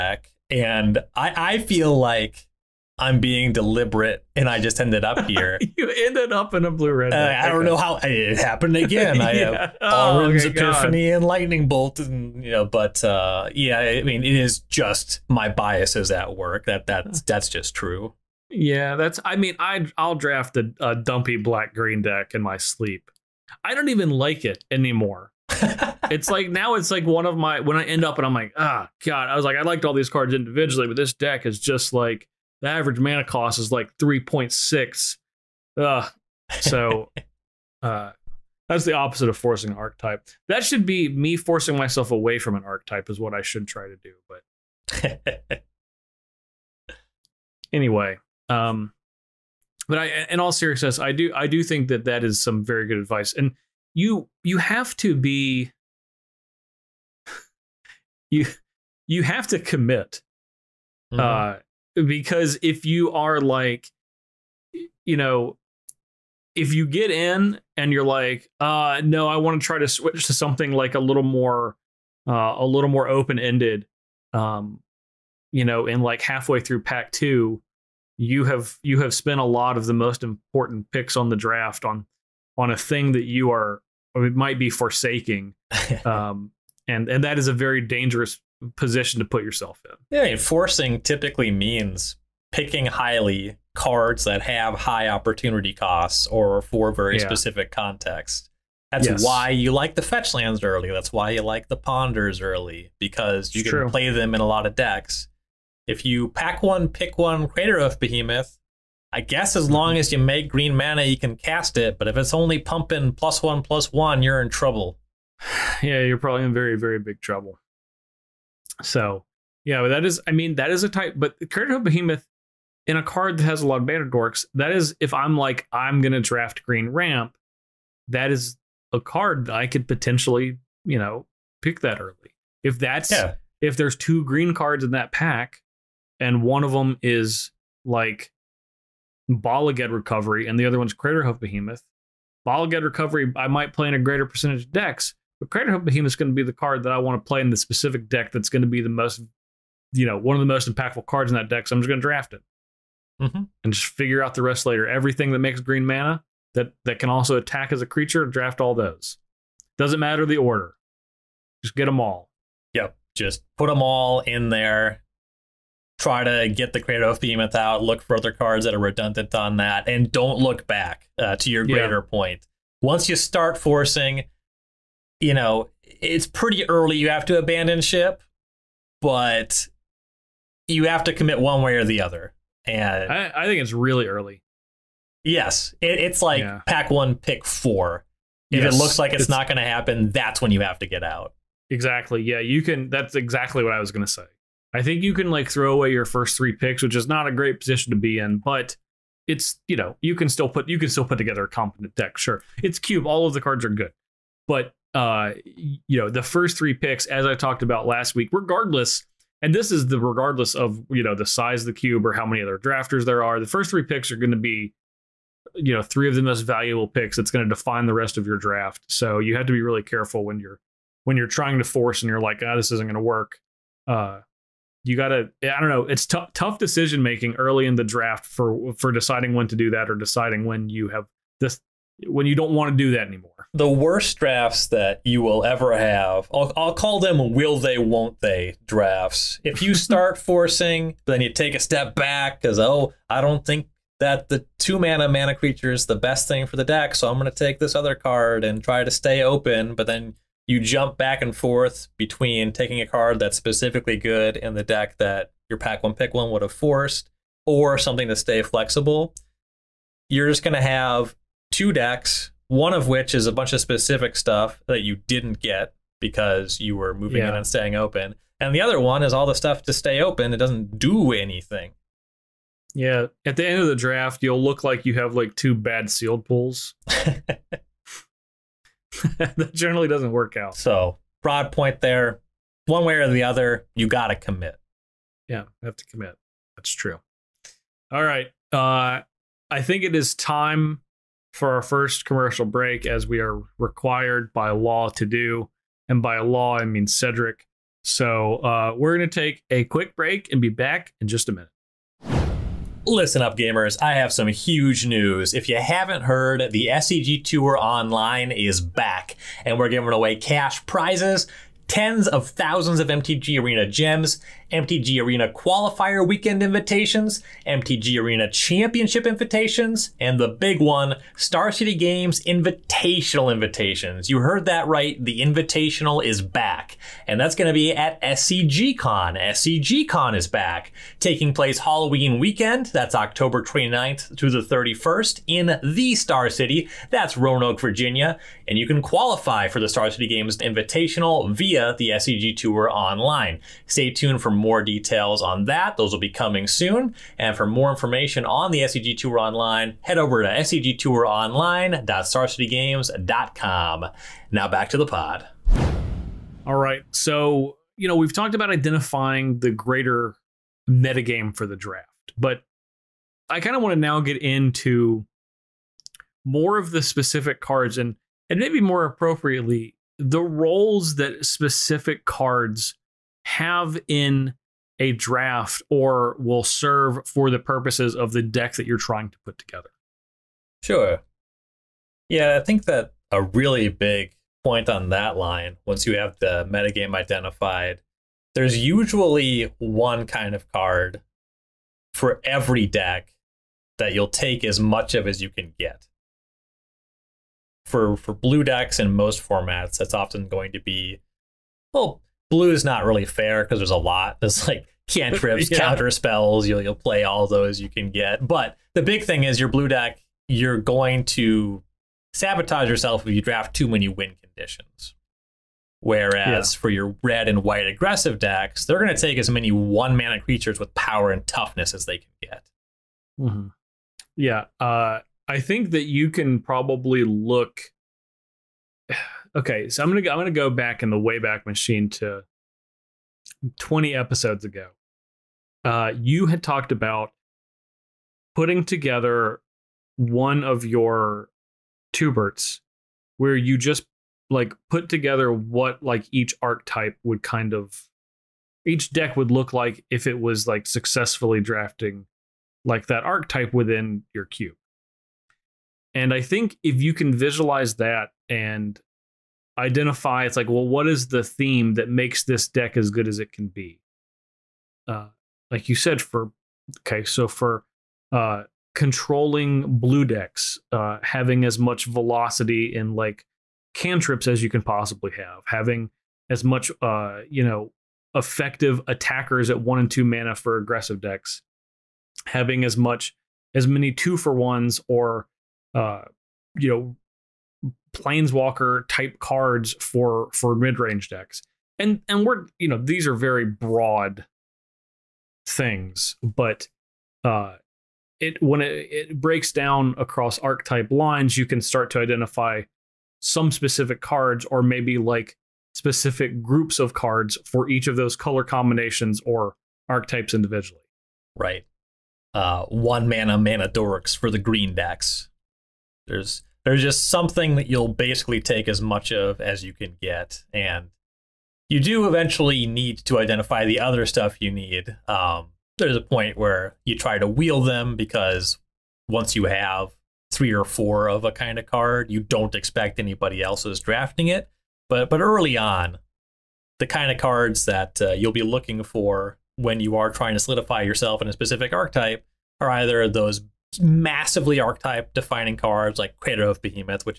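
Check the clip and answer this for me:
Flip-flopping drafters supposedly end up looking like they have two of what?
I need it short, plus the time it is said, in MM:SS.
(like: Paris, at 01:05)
Bad sealed pulls, at 04:35.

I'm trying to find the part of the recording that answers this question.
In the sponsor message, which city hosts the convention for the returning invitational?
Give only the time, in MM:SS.
05:37.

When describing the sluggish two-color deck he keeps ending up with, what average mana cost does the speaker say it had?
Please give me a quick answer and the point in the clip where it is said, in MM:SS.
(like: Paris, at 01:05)
3.6, at 00:33.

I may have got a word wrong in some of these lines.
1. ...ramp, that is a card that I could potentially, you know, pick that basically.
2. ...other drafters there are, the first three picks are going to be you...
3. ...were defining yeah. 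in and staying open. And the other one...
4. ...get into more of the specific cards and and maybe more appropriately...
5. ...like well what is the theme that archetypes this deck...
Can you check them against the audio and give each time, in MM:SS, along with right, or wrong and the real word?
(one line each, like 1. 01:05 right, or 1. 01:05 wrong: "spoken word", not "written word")
1. 02:06 wrong: "early", not "basically"
2. 03:32 right
3. 04:26 wrong: "moving", not "defining"
4. 06:04 right
5. 07:40 wrong: "makes", not "archetypes".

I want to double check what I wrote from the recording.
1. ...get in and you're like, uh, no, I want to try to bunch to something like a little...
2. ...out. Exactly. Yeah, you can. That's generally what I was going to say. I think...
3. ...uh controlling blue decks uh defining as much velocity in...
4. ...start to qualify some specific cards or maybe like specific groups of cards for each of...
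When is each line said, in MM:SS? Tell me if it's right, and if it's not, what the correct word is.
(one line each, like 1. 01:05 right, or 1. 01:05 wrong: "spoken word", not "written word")
1. 01:06 wrong: "switch", not "bunch"
2. 03:11 wrong: "exactly", not "generally"
3. 07:48 wrong: "having", not "defining"
4. 08:21 wrong: "identify", not "qualify".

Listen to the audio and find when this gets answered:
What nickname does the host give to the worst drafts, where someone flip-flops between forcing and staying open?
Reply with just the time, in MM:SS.
03:57.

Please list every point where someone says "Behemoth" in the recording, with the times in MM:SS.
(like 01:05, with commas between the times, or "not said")
01:47, 02:01, 02:21, 02:25, 02:47, 09:06.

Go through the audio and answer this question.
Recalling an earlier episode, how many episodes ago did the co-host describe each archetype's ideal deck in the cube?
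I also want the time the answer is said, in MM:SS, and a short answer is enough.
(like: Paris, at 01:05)
20, at 07:13.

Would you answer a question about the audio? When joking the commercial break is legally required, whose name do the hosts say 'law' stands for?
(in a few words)
Cedric.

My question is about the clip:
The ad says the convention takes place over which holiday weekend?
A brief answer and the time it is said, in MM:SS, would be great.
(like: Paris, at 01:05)
Halloween, at 05:31.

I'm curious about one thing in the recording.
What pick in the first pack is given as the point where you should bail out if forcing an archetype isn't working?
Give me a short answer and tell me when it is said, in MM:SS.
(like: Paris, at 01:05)
Pack 1, pick 4, at 03:06.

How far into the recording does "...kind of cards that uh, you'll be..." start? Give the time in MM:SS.
08:56.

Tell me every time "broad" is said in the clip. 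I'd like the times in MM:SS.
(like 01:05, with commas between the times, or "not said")
04:41, 08:13.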